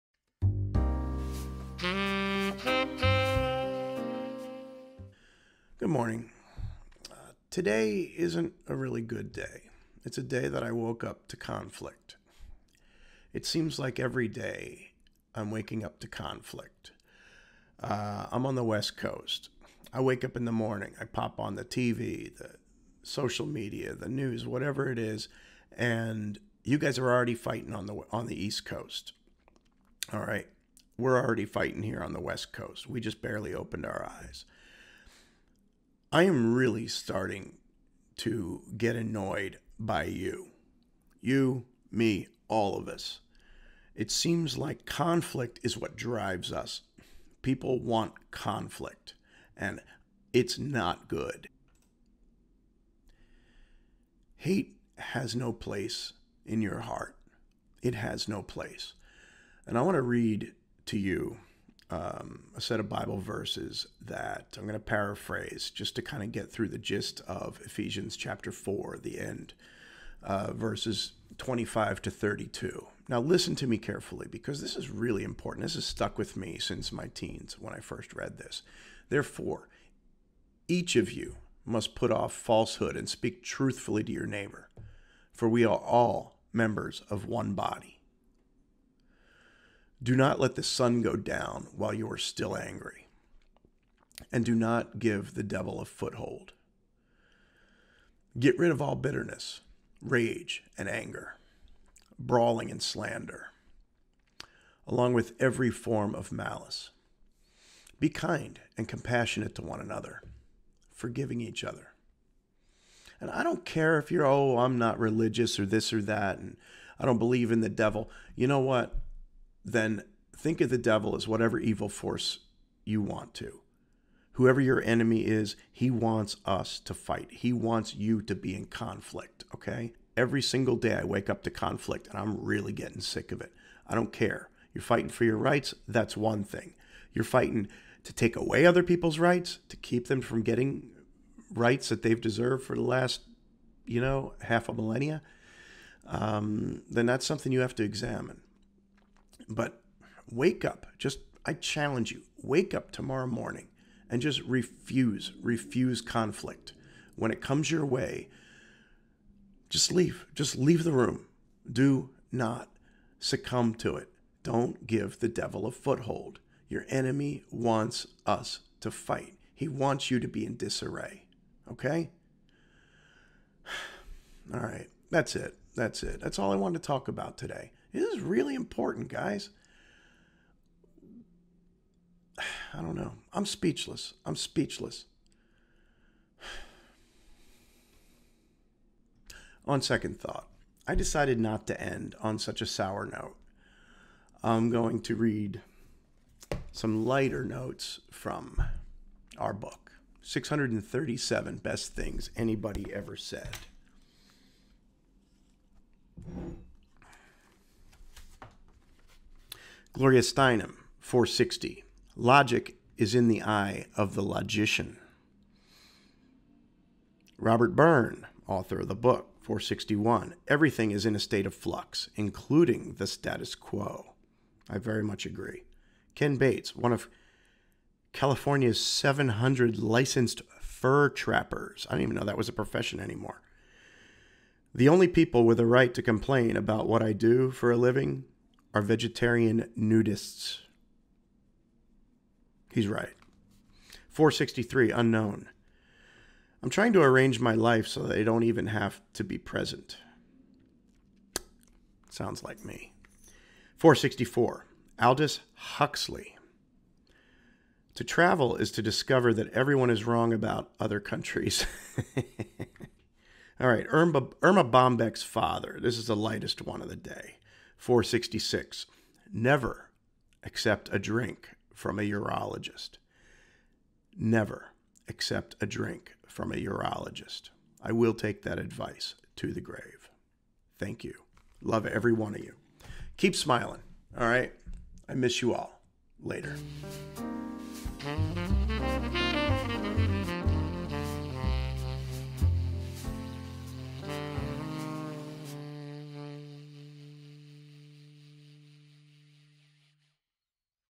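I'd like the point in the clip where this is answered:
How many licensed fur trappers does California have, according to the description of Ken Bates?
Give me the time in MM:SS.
03:48.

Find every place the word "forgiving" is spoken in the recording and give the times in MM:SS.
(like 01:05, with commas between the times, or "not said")
01:50.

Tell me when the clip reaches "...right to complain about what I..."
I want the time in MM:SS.
03:55.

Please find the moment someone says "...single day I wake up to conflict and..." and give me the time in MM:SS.
02:10.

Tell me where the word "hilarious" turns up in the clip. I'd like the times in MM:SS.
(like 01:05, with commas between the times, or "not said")
not said.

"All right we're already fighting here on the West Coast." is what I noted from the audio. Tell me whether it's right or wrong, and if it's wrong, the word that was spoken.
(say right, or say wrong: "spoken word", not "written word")
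right.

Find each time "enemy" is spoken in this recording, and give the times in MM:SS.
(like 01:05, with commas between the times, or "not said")
02:04, 02:46.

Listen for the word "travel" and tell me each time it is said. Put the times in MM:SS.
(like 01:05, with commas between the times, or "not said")
04:18.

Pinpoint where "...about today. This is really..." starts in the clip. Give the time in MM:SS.
02:57.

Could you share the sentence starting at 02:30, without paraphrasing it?
Just, I challenge you, wake up tomorrow morning and just refuse, refuse conflict.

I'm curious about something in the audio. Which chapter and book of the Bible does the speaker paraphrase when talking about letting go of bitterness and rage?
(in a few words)
Ephesians chapter 4.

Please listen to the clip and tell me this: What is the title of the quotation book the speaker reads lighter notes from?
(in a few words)
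637 Best Things Anybody Ever Said.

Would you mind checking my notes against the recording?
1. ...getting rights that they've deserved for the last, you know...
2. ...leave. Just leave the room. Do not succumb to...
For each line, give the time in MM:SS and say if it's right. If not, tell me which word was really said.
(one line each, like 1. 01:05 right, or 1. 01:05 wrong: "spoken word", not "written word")
1. 02:20 right
2. 02:39 right.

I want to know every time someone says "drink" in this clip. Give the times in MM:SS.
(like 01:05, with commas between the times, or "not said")
04:30, 04:35.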